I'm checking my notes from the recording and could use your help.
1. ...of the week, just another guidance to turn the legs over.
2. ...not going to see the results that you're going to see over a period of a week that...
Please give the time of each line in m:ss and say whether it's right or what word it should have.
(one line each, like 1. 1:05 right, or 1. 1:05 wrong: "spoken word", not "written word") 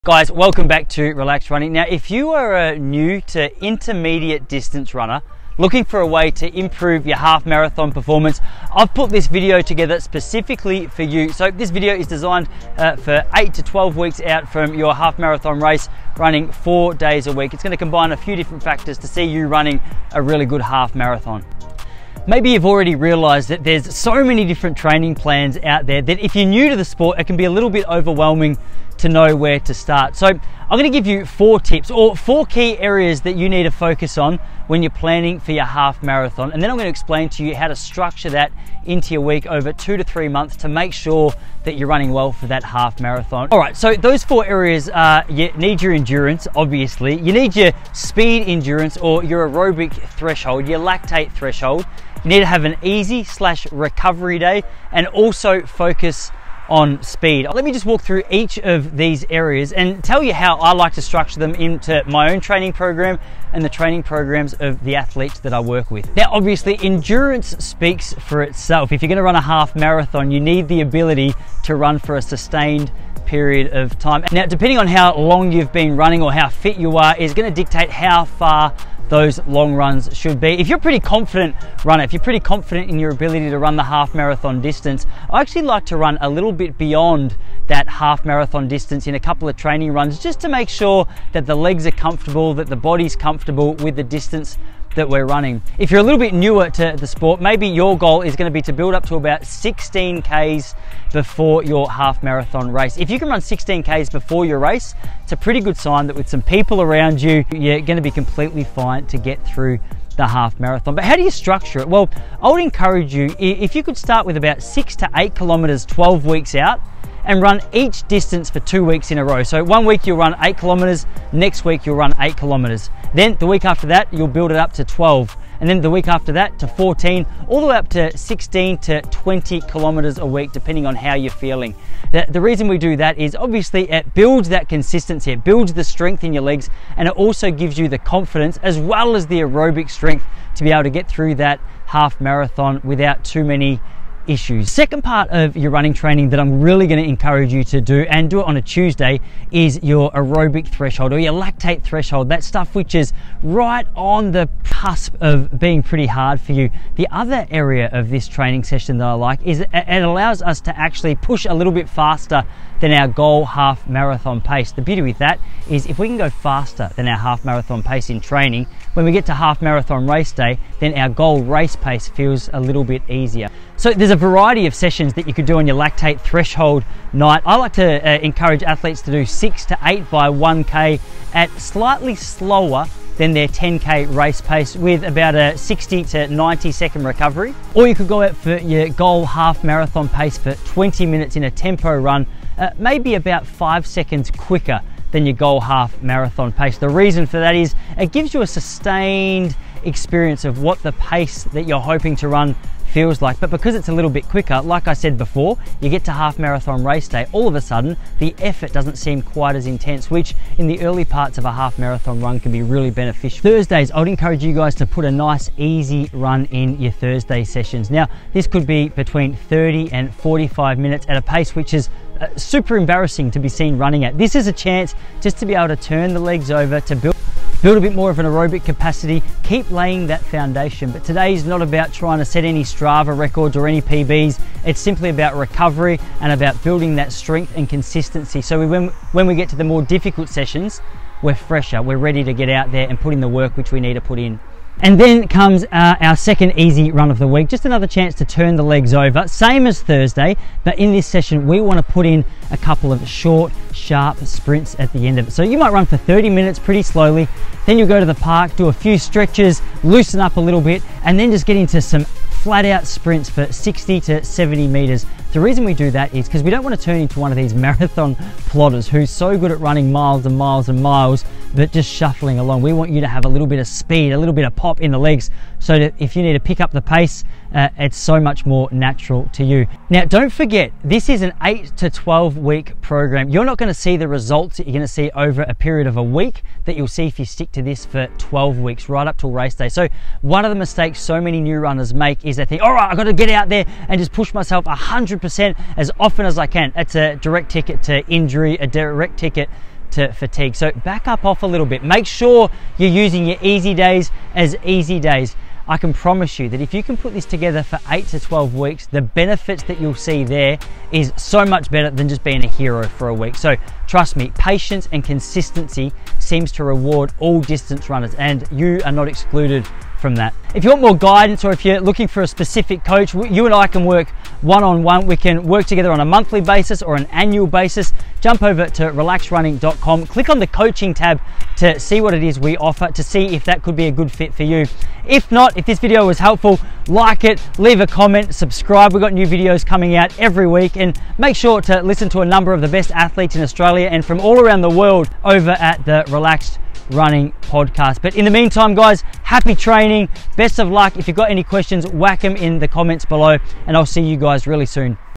1. 4:07 wrong: "chance", not "guidance"
2. 4:43 right.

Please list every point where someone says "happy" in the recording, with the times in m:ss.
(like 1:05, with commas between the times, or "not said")
5:49.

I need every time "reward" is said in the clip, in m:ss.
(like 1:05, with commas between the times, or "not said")
5:16.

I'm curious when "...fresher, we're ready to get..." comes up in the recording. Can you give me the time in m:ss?
4:01.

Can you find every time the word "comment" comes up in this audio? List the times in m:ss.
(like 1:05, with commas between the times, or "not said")
5:37, 5:52.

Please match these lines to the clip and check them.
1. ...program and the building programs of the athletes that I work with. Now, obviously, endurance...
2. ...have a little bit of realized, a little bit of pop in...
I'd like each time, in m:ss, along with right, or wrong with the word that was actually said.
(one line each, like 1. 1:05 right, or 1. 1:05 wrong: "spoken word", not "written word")
1. 1:02 wrong: "training", not "building"
2. 4:33 wrong: "speed", not "realized".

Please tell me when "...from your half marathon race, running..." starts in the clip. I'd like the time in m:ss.
0:14.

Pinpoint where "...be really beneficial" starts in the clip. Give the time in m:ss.
3:32.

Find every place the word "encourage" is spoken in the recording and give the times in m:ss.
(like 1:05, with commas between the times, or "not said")
1:52, 2:27, 2:58, 3:34.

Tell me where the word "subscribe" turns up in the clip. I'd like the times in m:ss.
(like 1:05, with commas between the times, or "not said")
5:38.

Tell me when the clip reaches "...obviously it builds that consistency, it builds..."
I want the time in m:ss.
2:13.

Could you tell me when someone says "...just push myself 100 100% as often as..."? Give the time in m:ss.
4:53.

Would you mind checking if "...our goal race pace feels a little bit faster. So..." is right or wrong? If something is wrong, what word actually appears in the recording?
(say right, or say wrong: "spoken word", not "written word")
wrong: "easier", not "faster".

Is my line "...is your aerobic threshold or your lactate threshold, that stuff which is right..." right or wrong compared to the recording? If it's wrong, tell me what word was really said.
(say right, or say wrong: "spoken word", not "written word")
right.